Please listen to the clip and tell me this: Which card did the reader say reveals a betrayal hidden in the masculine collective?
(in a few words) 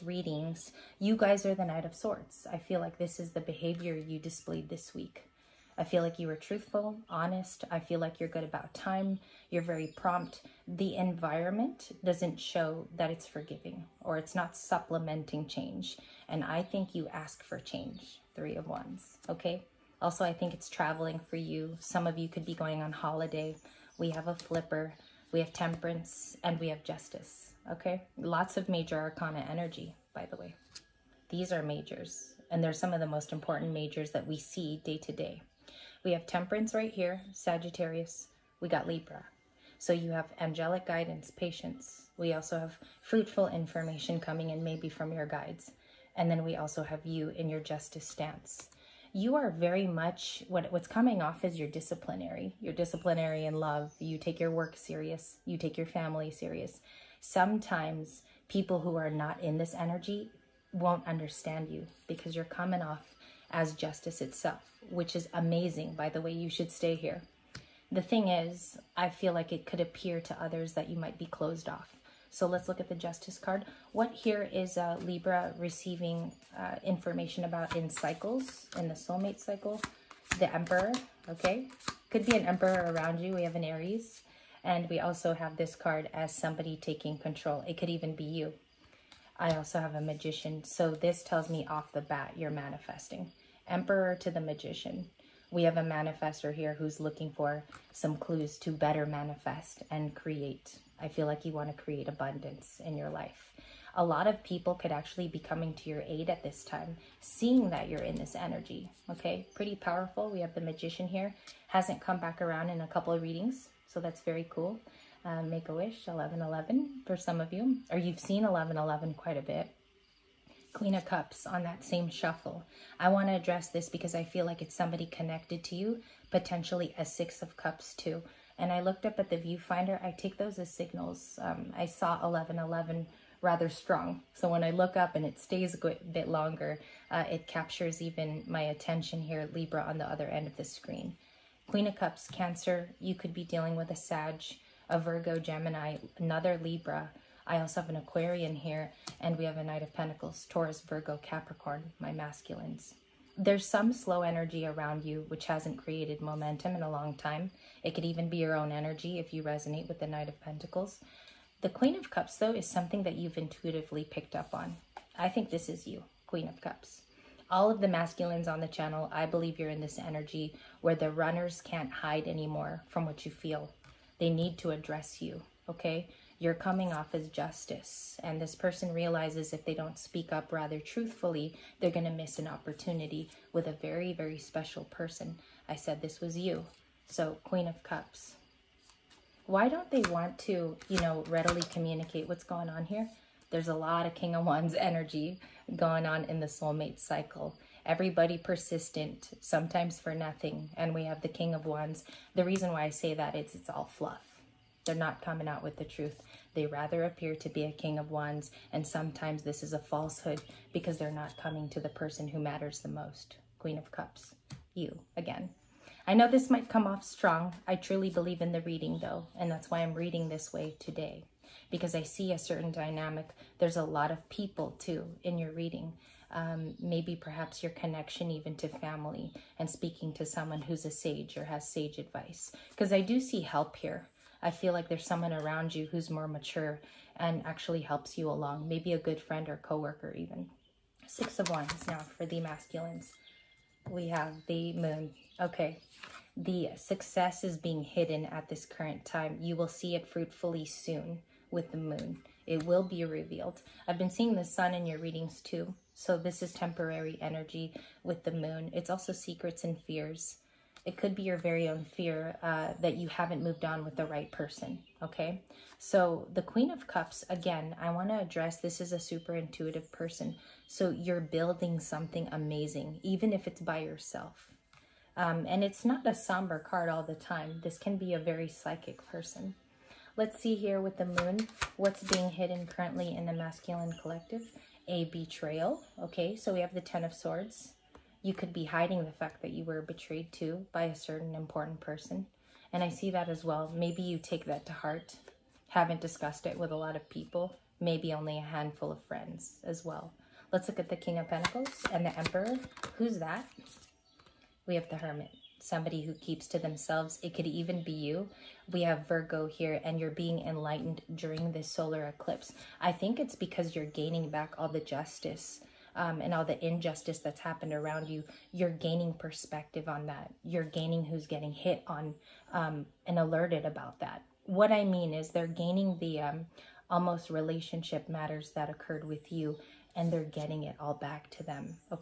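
Ten of Swords.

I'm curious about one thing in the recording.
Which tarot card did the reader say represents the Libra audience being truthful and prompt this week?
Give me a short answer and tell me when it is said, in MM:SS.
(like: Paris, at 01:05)
Knight of Swords, at 00:01.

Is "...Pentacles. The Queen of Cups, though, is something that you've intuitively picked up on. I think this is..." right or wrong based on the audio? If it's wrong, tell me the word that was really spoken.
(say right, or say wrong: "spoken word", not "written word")
right.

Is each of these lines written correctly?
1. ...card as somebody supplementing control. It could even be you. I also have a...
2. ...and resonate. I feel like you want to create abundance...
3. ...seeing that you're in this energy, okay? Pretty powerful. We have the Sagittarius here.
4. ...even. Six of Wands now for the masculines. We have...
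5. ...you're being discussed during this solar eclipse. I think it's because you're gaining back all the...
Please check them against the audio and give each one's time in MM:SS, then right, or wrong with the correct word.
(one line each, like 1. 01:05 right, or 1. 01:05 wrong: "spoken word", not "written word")
1. 01:25 wrong: "taking", not "supplementing"
2. 01:39 wrong: "create", not "resonate"
3. 01:47 wrong: "Magician", not "Sagittarius"
4. 04:00 right
5. 05:09 wrong: "enlightened", not "discussed".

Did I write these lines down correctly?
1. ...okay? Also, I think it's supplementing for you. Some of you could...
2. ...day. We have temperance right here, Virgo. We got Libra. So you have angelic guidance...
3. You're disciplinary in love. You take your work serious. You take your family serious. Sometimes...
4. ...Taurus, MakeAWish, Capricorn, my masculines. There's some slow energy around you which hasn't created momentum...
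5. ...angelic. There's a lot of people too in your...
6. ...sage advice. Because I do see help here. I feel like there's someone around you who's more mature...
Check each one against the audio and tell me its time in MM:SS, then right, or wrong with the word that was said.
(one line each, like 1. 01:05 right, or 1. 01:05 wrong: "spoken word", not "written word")
1. 00:19 wrong: "traveling", not "supplementing"
2. 00:35 wrong: "Sagittarius", not "Virgo"
3. 00:52 right
4. 02:30 wrong: "Virgo", not "MakeAWish"
5. 03:42 wrong: "dynamic", not "angelic"
6. 03:51 right.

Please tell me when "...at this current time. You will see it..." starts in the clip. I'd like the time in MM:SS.
04:08.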